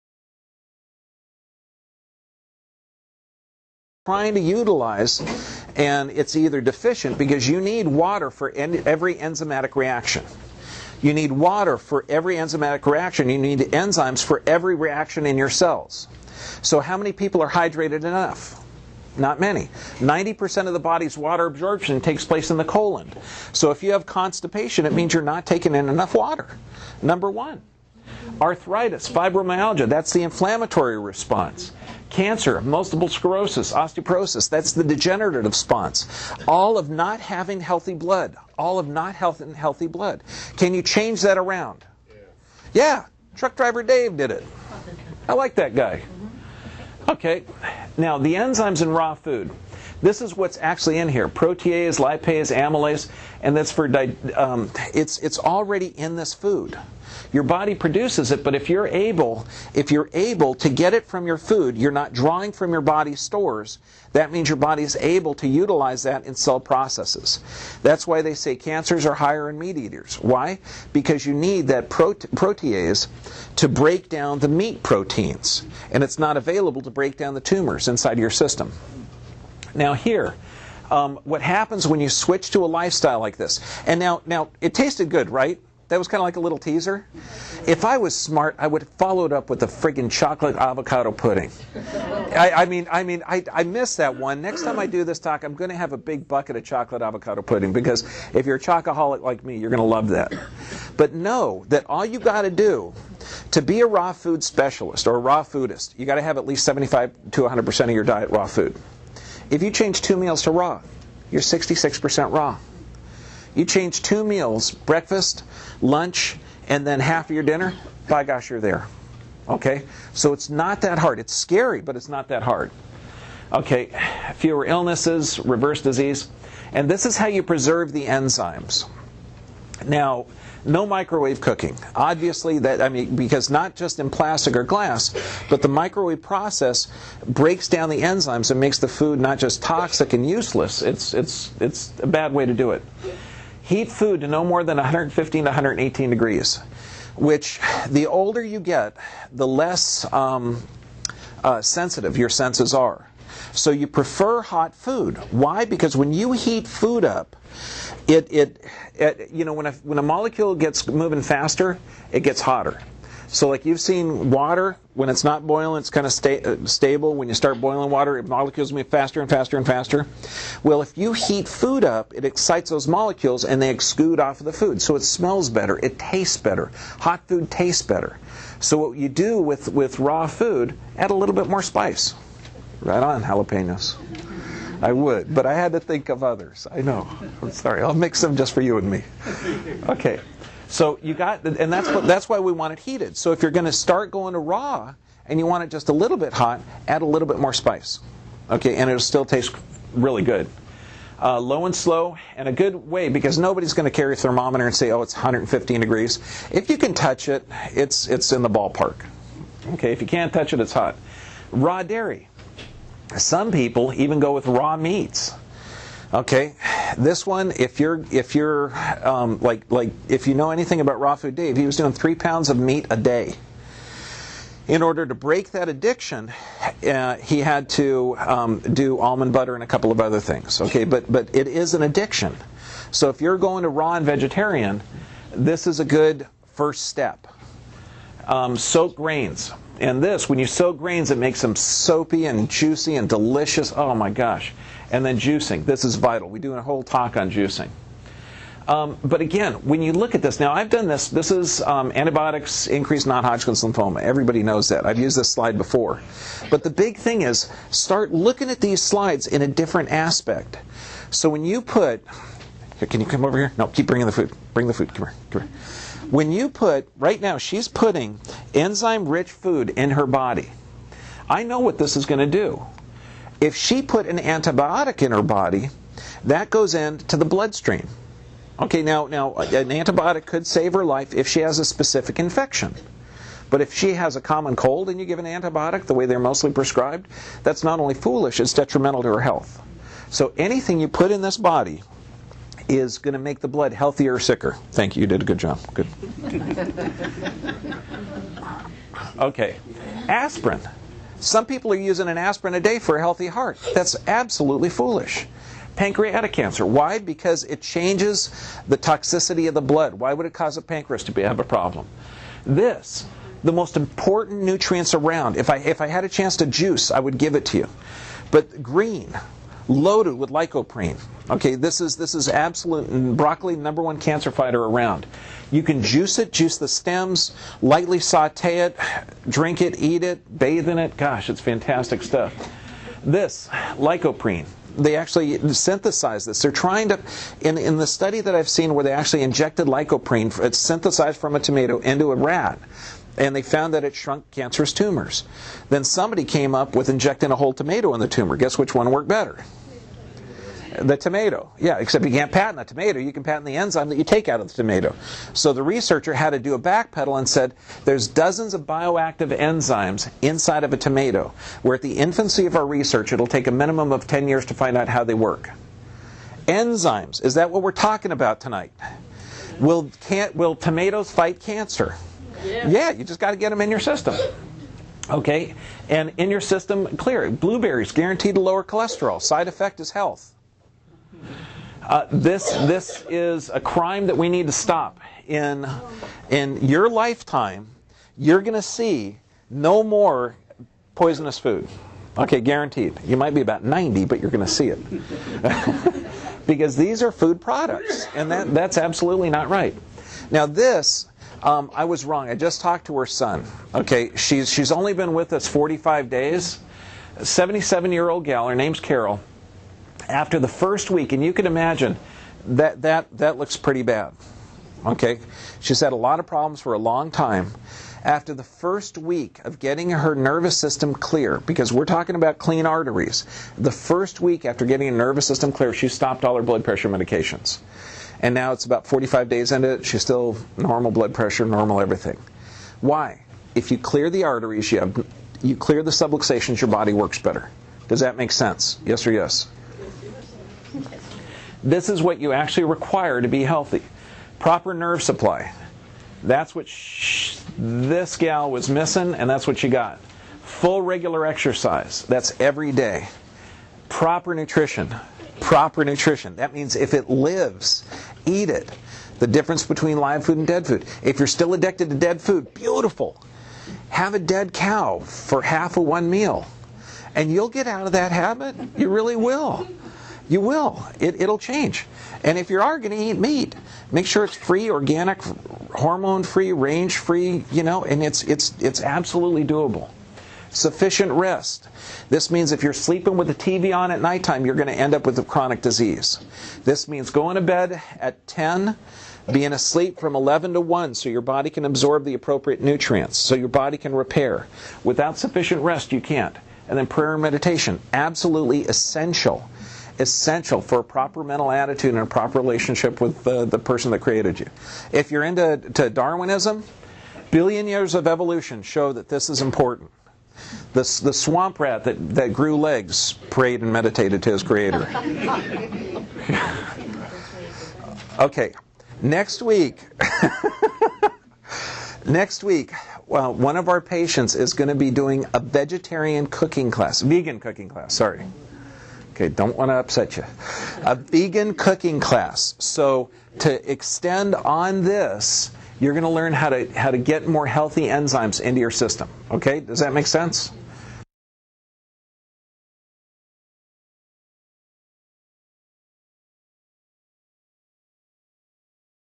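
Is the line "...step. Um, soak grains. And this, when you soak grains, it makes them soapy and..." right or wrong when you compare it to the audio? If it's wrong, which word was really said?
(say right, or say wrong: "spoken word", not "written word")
right.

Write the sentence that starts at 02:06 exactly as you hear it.
And this is how you preserve the enzymes.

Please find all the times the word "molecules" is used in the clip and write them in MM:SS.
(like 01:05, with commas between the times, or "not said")
02:40, 02:48, 02:52.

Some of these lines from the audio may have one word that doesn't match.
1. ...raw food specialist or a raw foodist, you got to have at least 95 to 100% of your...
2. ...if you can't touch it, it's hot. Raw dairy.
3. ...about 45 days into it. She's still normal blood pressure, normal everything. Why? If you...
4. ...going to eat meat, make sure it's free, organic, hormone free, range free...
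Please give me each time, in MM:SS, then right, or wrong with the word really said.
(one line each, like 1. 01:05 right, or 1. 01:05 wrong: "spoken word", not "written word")
1. 01:43 wrong: "75", not "95"
2. 03:29 right
3. 07:08 right
4. 07:52 right.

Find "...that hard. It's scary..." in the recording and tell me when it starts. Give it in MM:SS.
02:00.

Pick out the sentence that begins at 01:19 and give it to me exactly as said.
Now here, um, what happens when you switch to a lifestyle like this?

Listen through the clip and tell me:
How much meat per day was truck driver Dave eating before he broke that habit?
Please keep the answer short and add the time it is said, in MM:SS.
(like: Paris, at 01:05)
three pounds, at 03:41.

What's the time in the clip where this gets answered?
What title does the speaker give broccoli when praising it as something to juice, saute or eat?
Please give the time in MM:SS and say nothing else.
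05:23.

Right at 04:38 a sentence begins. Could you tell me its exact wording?
Okay, now, now an antibiotic could save her life if she has a specific infection.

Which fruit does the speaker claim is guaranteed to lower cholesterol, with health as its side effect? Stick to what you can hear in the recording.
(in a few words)
Blueberries.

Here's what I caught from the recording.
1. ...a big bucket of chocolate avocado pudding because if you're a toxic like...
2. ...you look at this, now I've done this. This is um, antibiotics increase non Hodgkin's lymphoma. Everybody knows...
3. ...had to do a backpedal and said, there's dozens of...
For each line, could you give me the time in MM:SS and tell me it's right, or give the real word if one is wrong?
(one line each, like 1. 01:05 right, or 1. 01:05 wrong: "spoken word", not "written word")
1. 01:35 wrong: "chocoholic", not "toxic"
2. 04:09 right
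3. 05:56 right.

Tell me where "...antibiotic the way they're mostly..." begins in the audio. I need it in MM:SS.
04:45.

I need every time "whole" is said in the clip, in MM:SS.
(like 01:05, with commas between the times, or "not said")
04:06, 05:47.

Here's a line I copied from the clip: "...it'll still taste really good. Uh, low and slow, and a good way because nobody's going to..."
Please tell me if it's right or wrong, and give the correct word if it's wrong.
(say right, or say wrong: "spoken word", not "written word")
right.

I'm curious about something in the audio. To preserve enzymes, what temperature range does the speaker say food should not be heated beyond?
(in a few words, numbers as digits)
115 to 118 degrees.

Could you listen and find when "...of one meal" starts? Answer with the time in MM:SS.
07:45.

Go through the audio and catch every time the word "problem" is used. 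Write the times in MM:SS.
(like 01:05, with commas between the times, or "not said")
05:11, 06:56.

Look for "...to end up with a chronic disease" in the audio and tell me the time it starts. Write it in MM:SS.
08:04.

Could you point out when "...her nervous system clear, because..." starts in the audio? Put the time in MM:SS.
06:59.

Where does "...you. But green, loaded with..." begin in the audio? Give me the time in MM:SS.
05:17.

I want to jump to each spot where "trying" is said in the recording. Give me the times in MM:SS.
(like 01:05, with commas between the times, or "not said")
00:04, 05:36.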